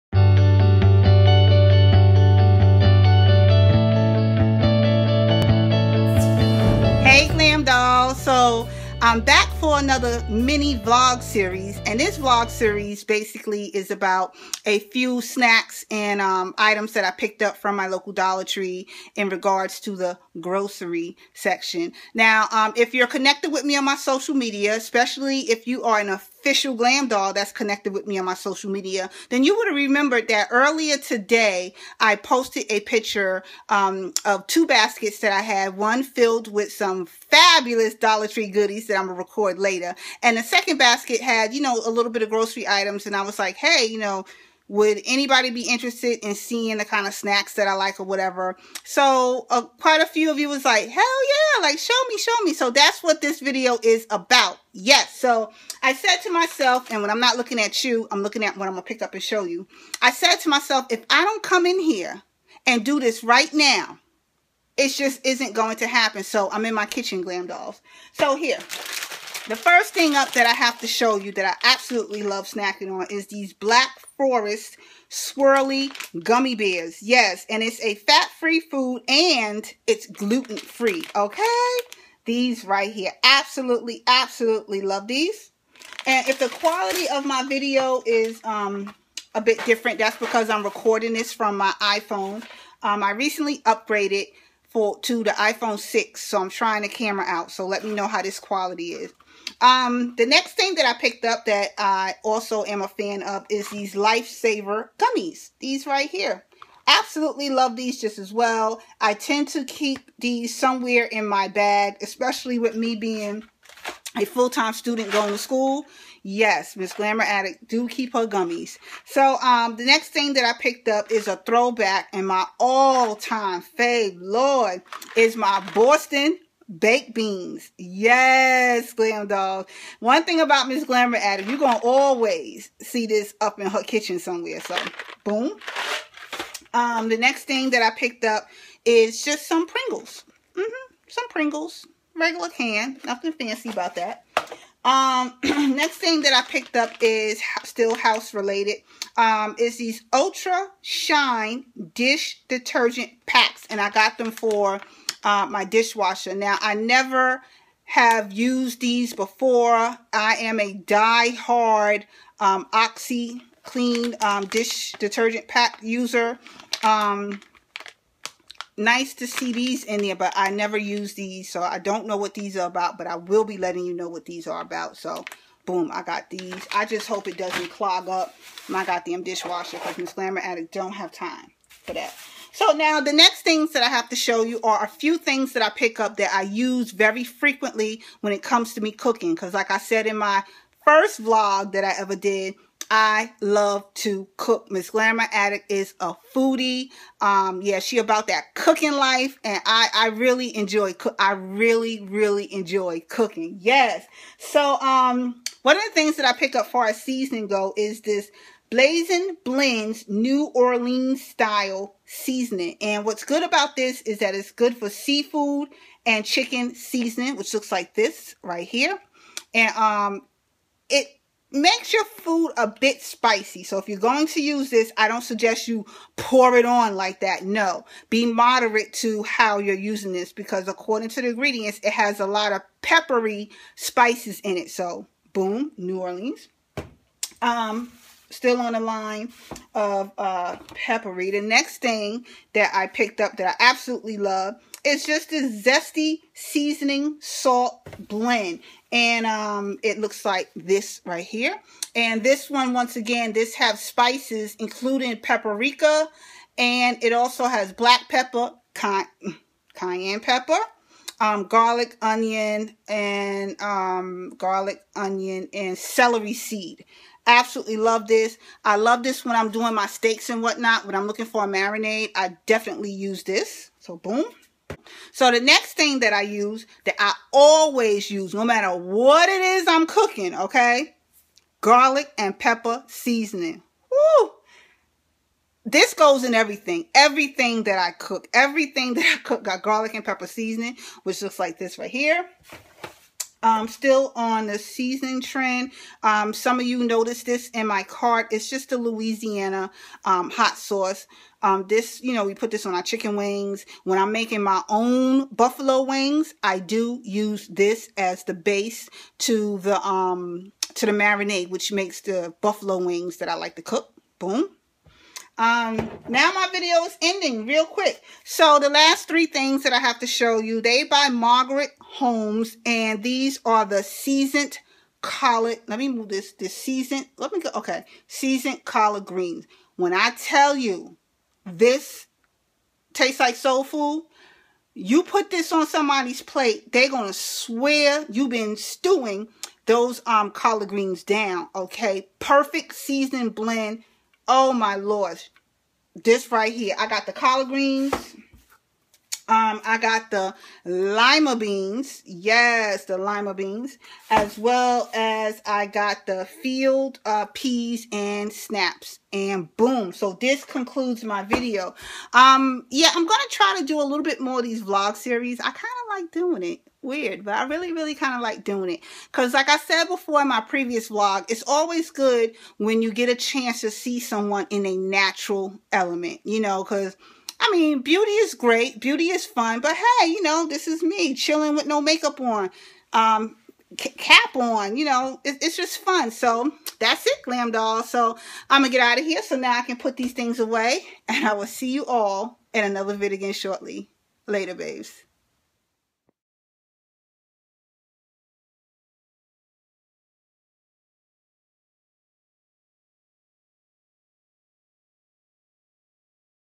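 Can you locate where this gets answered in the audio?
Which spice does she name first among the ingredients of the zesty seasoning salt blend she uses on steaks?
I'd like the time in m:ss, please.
4:15.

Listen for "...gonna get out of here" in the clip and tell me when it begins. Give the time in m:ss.
6:28.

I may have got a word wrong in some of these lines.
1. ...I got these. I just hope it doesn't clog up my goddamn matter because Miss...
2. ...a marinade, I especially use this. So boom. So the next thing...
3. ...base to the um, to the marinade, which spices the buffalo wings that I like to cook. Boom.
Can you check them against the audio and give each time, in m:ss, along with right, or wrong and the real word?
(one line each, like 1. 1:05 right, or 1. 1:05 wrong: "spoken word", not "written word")
1. 2:55 wrong: "dishwasher", not "matter"
2. 4:31 wrong: "definitely", not "especially"
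3. 5:08 wrong: "makes", not "spices".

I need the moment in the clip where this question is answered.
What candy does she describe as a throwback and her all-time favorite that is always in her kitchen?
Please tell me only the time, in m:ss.
2:05.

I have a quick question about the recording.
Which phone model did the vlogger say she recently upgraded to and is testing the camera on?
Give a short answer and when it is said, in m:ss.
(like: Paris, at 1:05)
iPhone 6, at 1:35.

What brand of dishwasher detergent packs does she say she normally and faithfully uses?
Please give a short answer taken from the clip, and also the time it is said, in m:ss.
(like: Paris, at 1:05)
Oxy Clean, at 2:42.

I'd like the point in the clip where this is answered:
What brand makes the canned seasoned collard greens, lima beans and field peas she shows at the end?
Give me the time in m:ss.
5:21.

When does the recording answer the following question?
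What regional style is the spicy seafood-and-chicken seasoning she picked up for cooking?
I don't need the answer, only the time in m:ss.
3:30.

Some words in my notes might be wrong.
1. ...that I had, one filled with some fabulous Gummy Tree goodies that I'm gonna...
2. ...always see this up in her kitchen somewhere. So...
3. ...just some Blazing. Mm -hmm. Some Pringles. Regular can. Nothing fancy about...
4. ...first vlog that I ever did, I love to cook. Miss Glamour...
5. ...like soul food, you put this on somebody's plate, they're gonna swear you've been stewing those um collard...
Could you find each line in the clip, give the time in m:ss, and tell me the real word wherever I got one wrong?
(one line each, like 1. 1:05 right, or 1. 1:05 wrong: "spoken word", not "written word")
1. 0:35 wrong: "Dollar", not "Gummy"
2. 2:11 right
3. 2:19 wrong: "Pringles", not "Blazing"
4. 3:10 right
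5. 5:33 right.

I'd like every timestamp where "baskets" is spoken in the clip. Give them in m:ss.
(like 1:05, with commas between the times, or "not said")
0:34, 0:40.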